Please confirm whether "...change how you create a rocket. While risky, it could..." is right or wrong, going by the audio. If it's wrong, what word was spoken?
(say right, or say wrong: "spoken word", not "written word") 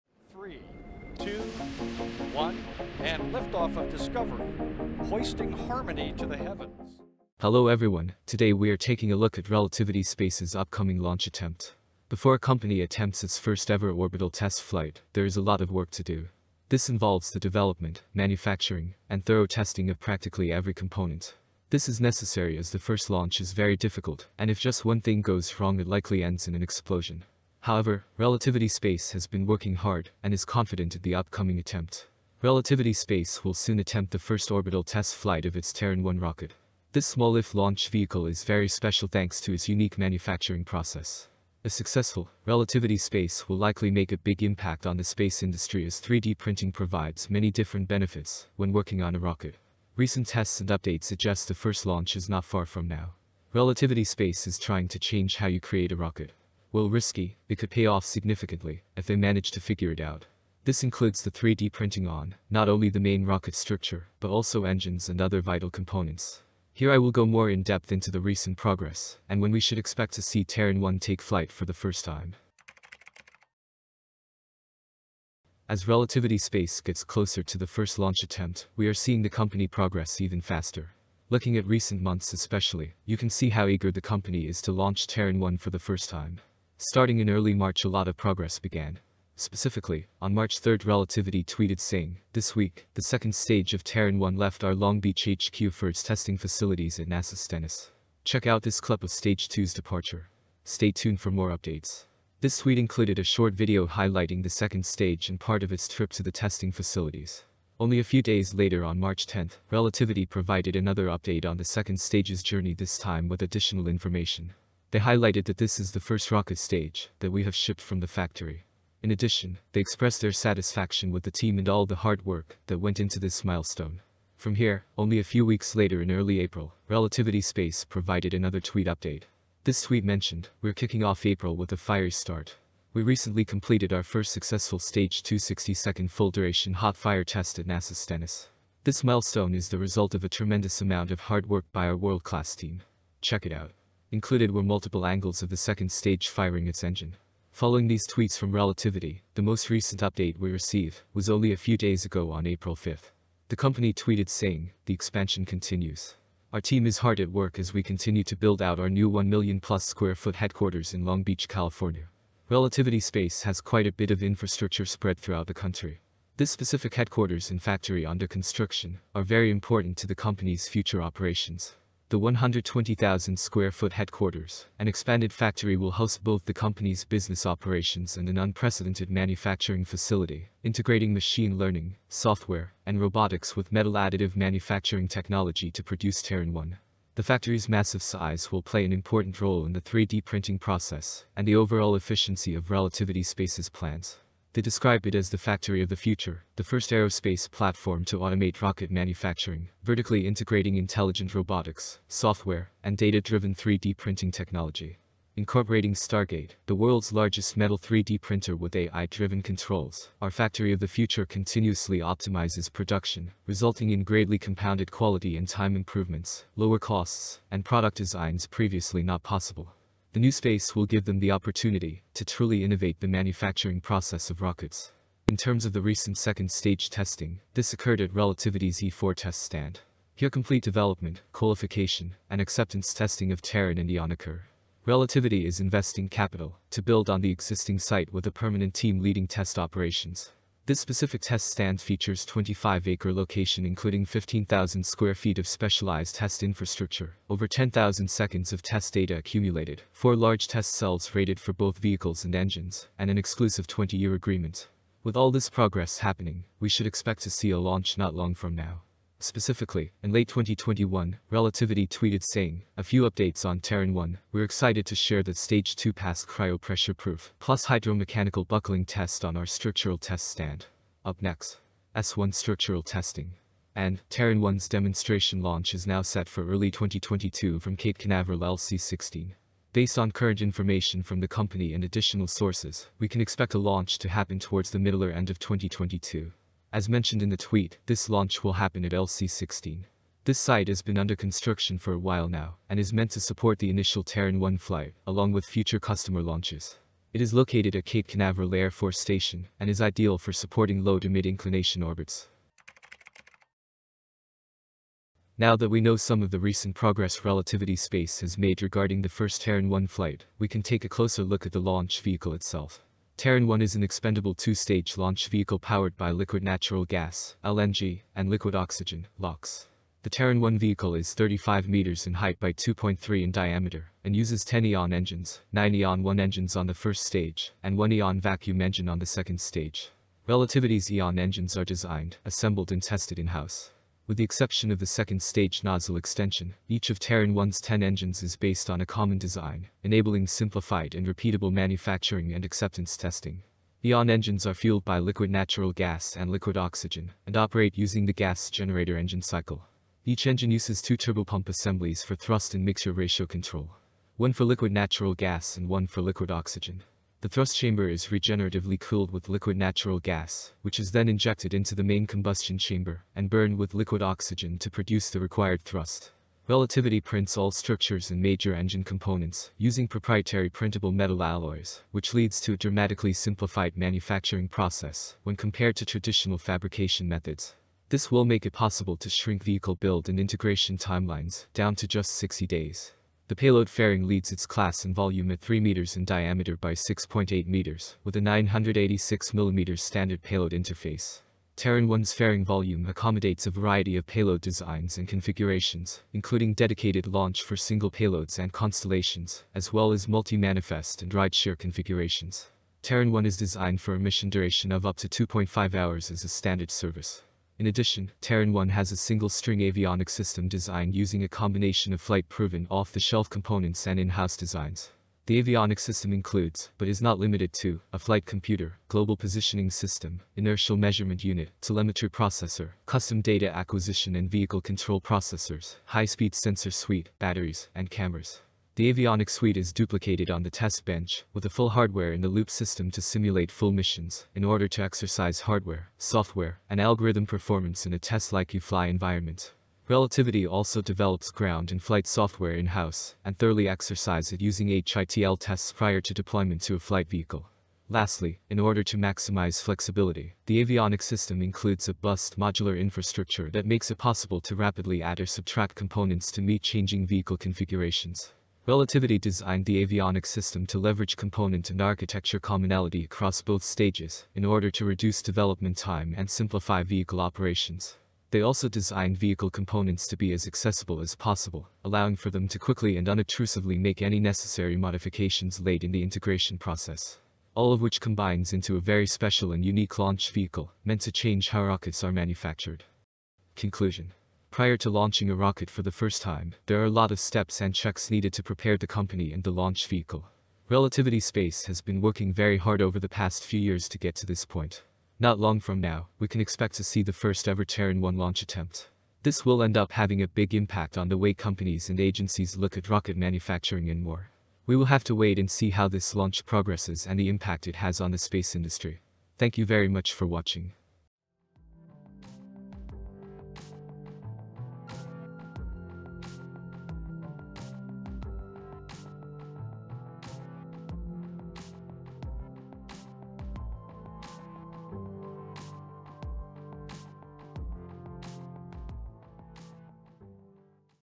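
right.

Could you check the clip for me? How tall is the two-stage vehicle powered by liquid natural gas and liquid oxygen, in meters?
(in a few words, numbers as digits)
35 meters.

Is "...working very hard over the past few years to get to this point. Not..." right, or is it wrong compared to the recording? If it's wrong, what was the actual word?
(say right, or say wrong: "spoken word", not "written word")
right.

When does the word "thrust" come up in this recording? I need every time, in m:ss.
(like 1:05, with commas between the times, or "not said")
5:52, 5:57, 6:05.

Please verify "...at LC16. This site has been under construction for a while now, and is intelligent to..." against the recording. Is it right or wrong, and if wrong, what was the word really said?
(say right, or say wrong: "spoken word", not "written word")
wrong: "meant", not "intelligent".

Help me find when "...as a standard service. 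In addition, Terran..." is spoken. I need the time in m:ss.
6:46.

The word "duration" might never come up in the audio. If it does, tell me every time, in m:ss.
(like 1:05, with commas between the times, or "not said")
2:16, 6:44.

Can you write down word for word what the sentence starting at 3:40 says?
The new space will give them the opportunity to truly innovate the manufacturing process of rockets.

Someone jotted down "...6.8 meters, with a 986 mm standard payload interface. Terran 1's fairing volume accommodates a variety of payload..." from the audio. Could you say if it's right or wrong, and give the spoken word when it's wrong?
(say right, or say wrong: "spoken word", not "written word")
right.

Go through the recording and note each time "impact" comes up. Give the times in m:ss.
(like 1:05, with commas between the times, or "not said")
0:44, 8:20, 8:27.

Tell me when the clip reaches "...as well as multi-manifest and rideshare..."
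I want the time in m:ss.
6:39.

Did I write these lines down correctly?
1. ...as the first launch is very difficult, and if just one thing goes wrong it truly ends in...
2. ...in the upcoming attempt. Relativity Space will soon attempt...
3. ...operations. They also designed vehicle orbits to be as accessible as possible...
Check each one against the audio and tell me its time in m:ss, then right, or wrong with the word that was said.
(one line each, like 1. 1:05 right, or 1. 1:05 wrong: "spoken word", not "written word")
1. 0:22 wrong: "likely", not "truly"
2. 0:30 right
3. 7:47 wrong: "components", not "orbits".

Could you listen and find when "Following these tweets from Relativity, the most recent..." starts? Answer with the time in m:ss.
2:27.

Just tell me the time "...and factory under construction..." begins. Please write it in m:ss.
2:47.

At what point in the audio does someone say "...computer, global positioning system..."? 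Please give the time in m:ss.
6:58.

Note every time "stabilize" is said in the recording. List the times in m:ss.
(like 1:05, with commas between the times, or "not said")
not said.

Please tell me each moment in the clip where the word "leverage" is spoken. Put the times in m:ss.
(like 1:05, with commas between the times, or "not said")
7:40.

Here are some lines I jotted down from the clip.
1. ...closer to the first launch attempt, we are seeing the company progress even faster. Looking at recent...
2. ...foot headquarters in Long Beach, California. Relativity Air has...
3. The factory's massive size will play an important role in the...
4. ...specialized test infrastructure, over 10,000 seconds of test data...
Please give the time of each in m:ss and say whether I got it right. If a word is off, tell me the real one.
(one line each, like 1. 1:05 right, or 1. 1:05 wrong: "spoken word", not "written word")
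1. 1:17 right
2. 2:40 wrong: "Space", not "Air"
3. 3:07 right
4. 4:05 right.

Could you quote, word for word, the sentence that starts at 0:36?
This small lift launch vehicle is very special thanks to its unique manufacturing process.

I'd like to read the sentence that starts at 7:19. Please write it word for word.
Relativity also develops ground and flight software in-house, and thoroughly exercises it using HITL tests prior to deployment to a flight vehicle.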